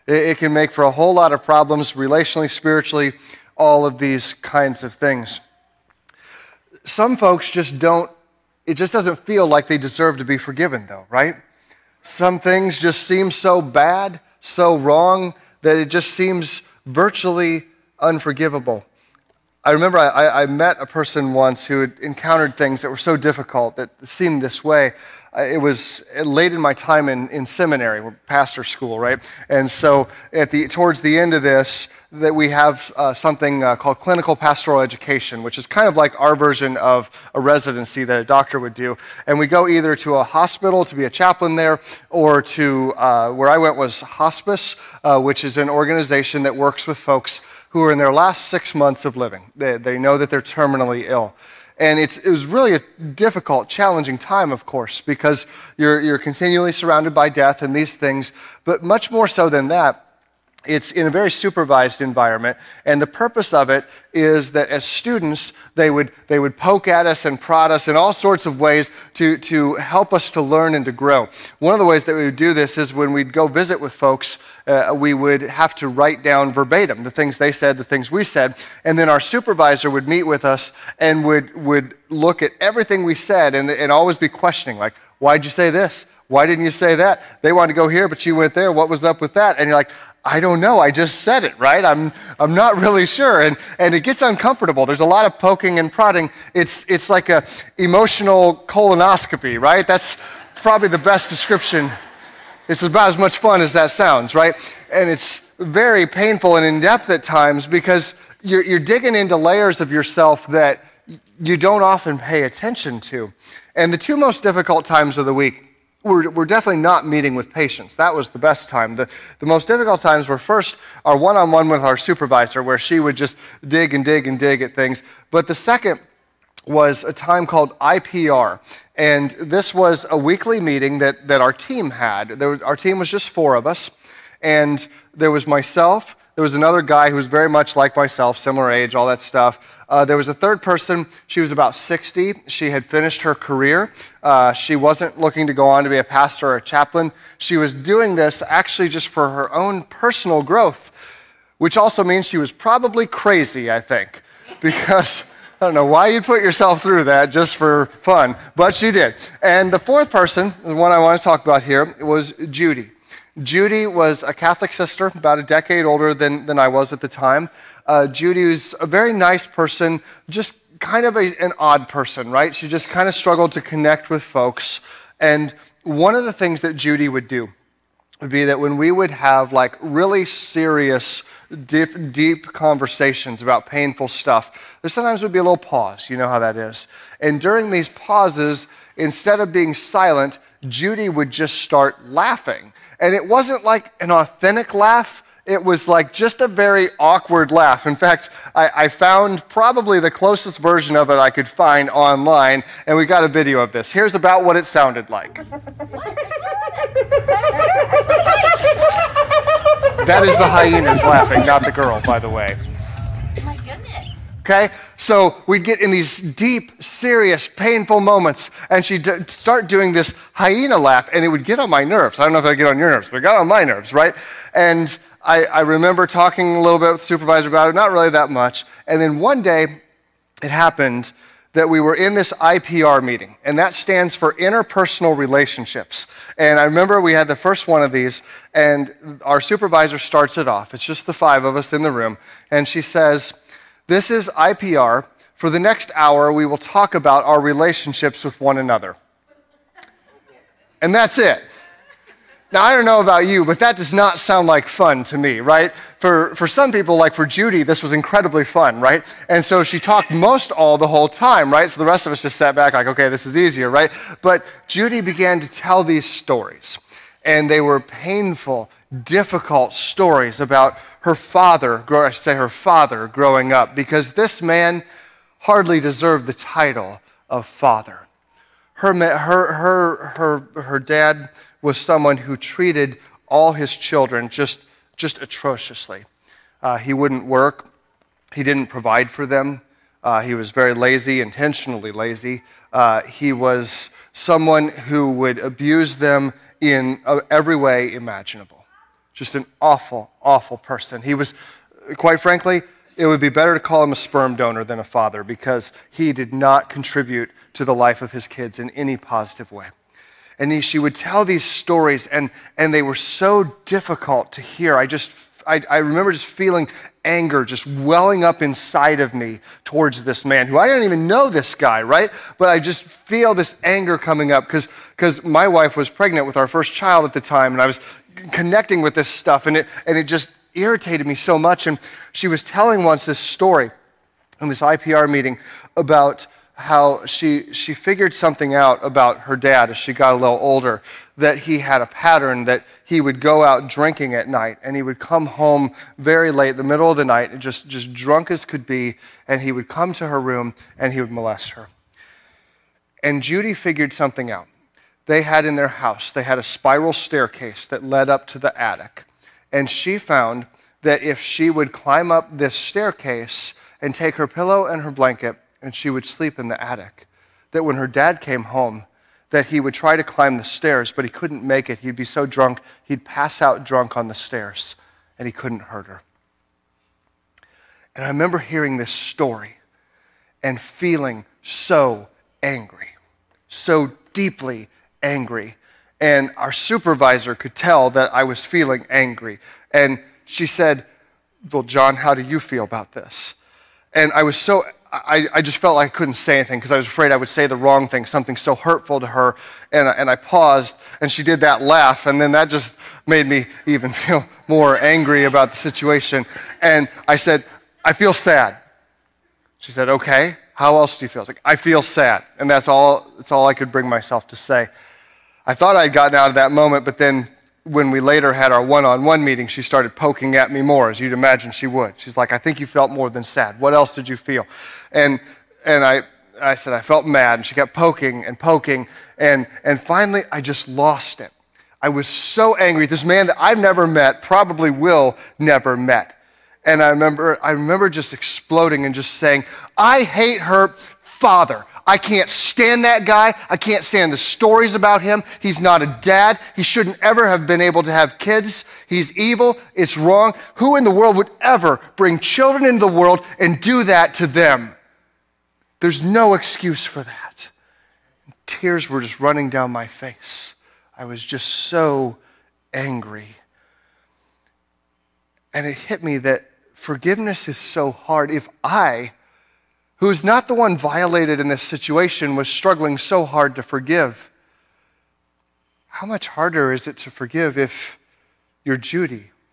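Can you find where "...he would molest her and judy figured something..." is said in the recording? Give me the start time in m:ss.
5:50.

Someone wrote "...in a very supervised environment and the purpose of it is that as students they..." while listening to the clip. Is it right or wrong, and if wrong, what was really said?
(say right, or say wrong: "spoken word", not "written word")
right.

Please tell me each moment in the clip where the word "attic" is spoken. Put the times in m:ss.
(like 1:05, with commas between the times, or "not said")
5:58, 6:06.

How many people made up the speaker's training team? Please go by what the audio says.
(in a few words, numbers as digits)
4.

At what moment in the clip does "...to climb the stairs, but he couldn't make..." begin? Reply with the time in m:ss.
6:09.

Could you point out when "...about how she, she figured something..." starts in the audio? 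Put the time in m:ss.
5:35.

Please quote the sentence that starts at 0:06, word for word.
Some folks just don't, it just doesn't feel like they deserve to be forgiven, though, right?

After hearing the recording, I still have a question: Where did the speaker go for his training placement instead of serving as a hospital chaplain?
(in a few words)
Hospice.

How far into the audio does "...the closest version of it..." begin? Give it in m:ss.
3:19.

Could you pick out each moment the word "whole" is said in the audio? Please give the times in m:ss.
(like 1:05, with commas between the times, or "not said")
0:00, 4:20.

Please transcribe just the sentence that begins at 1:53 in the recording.
And the two most difficult times of the week we're, definitely not meeting with patients.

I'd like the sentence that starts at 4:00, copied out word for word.
It's just the five of us in the room, and she says, This is IPR.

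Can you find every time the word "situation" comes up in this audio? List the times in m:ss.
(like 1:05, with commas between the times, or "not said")
6:45, 7:51.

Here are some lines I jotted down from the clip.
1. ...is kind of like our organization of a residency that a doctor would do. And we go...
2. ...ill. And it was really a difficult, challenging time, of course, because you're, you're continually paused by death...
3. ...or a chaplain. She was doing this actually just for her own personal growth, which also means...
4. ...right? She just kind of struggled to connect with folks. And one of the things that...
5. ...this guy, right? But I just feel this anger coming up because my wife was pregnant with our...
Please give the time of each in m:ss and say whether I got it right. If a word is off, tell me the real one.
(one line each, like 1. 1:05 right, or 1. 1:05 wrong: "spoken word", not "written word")
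1. 0:35 wrong: "version", not "organization"
2. 0:51 wrong: "surrounded", not "paused"
3. 2:26 right
4. 2:52 right
5. 5:21 right.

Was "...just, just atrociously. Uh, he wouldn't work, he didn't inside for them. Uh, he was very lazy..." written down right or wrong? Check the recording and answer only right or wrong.
wrong.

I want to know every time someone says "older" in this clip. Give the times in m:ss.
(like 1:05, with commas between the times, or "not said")
2:45, 5:40.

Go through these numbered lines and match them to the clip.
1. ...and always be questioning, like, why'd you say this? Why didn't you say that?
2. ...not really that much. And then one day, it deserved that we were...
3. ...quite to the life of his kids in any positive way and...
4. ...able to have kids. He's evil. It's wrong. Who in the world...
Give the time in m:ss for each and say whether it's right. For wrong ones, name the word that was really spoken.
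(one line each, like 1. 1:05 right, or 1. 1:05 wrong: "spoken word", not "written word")
1. 1:23 right
2. 3:47 wrong: "happened", not "deserved"
3. 5:06 wrong: "contribute", not "quite"
4. 7:27 right.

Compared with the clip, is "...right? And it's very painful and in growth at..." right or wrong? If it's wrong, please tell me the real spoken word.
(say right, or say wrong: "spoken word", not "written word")
wrong: "depth", not "growth".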